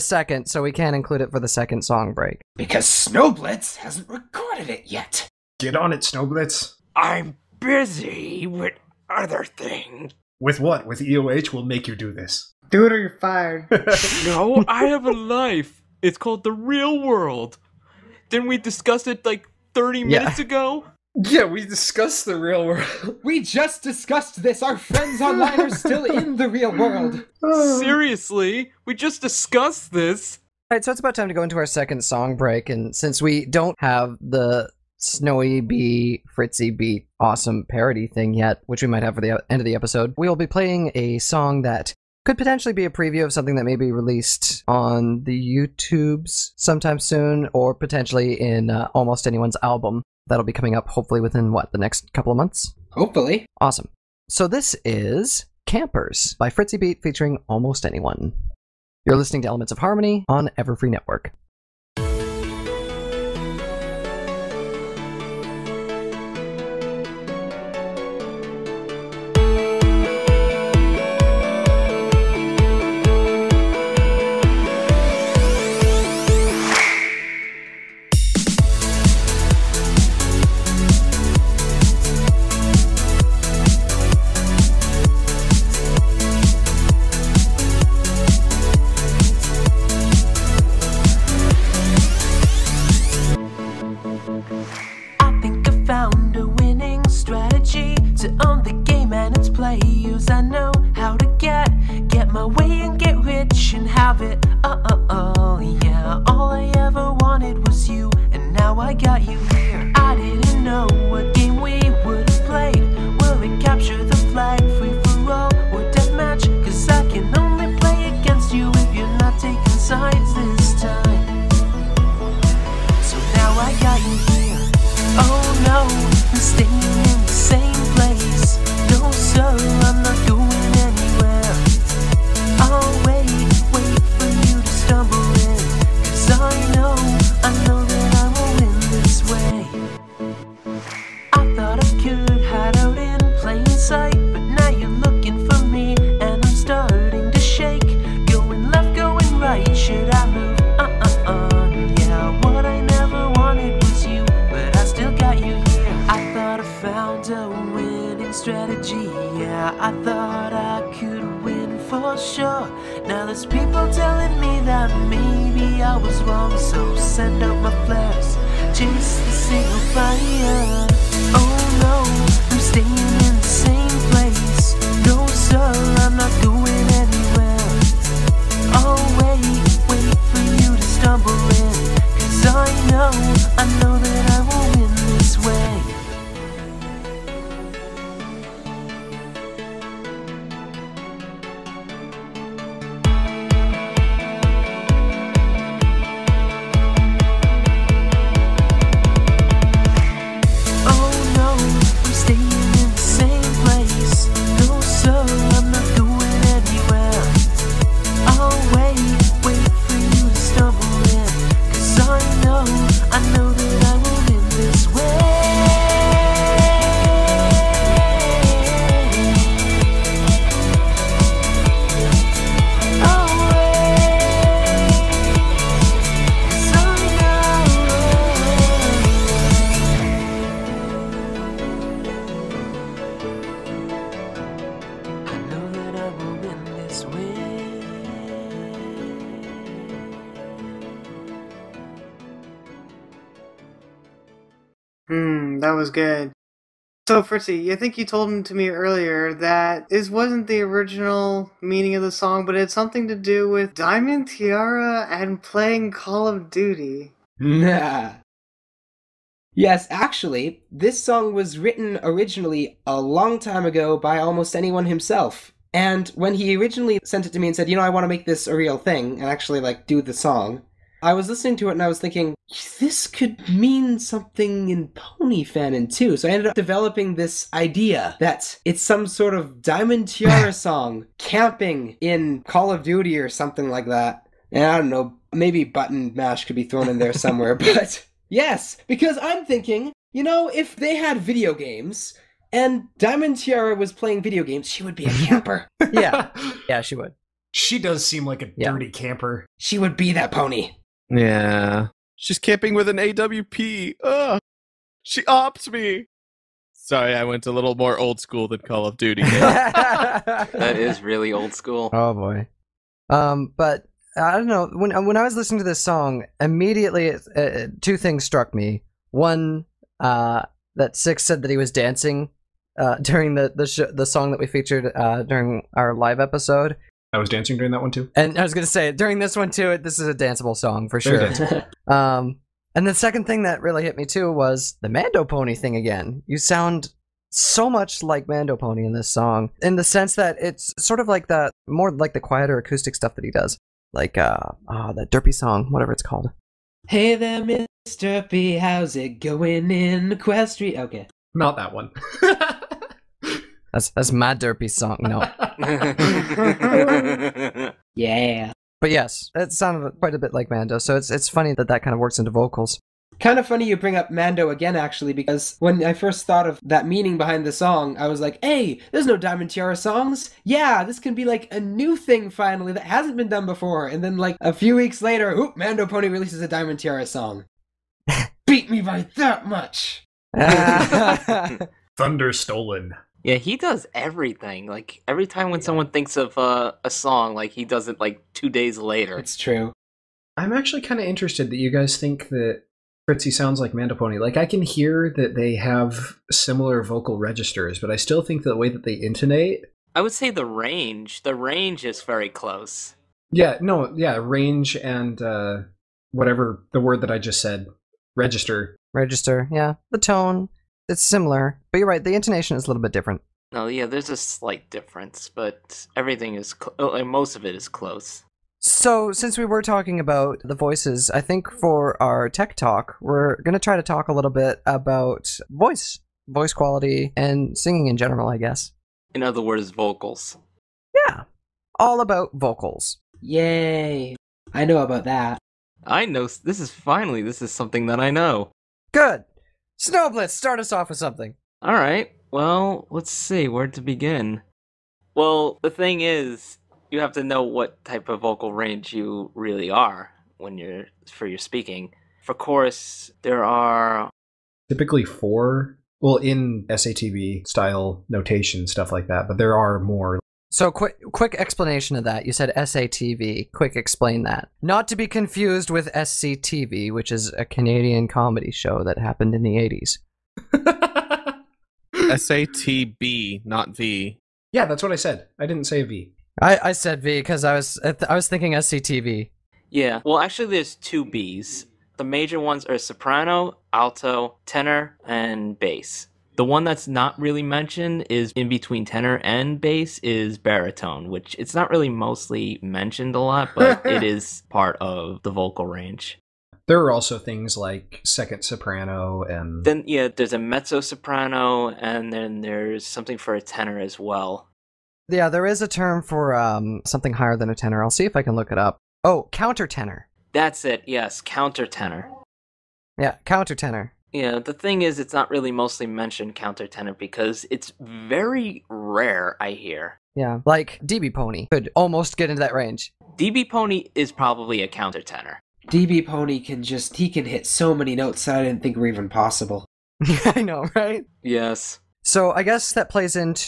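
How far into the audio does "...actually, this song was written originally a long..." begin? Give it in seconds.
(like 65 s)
259 s.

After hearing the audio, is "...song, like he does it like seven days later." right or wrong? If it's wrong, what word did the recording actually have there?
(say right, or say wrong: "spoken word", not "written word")
wrong: "two", not "seven".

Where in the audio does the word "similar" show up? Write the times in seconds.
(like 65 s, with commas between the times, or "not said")
396 s, 411 s.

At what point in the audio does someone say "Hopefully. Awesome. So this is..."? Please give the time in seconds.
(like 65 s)
52 s.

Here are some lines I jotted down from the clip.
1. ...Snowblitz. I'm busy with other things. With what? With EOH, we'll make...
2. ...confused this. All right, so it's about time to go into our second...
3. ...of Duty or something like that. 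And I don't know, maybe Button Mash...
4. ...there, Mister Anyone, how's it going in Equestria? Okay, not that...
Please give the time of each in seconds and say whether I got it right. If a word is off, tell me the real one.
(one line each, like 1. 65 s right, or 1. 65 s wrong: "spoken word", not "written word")
1. 5 s right
2. 29 s wrong: "discussed", not "confused"
3. 282 s right
4. 347 s wrong: "Derpy", not "Anyone".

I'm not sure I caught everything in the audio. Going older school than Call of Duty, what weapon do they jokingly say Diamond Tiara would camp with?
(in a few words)
AWP.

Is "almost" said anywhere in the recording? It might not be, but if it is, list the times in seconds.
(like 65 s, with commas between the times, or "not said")
48 s, 57 s, 264 s, 521 s.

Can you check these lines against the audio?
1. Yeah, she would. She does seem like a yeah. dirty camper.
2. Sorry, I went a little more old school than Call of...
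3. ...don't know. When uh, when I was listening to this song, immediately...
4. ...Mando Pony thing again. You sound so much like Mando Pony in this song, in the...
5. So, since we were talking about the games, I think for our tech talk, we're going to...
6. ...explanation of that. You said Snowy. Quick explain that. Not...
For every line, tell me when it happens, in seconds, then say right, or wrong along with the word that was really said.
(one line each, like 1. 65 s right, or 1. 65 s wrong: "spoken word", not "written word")
1. 296 s right
2. 306 s right
3. 314 s right
4. 334 s right
5. 418 s wrong: "voices", not "games"
6. 461 s wrong: "SATV", not "Snowy".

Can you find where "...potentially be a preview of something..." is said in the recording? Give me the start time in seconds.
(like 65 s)
42 s.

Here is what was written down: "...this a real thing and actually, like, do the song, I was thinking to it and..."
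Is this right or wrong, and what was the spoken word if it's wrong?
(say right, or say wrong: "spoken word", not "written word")
wrong: "listening", not "thinking".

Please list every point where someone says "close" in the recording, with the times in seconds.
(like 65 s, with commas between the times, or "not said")
402 s, 417 s.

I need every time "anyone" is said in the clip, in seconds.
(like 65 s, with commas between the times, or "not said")
49 s, 57 s, 264 s.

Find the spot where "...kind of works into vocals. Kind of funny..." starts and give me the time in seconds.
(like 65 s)
361 s.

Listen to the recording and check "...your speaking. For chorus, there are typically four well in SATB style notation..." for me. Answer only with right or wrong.
right.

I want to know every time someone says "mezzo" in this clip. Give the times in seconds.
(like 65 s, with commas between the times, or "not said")
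500 s.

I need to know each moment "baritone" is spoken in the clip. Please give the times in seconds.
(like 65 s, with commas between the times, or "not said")
490 s.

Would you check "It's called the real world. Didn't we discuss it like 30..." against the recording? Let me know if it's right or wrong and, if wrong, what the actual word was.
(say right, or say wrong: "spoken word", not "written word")
right.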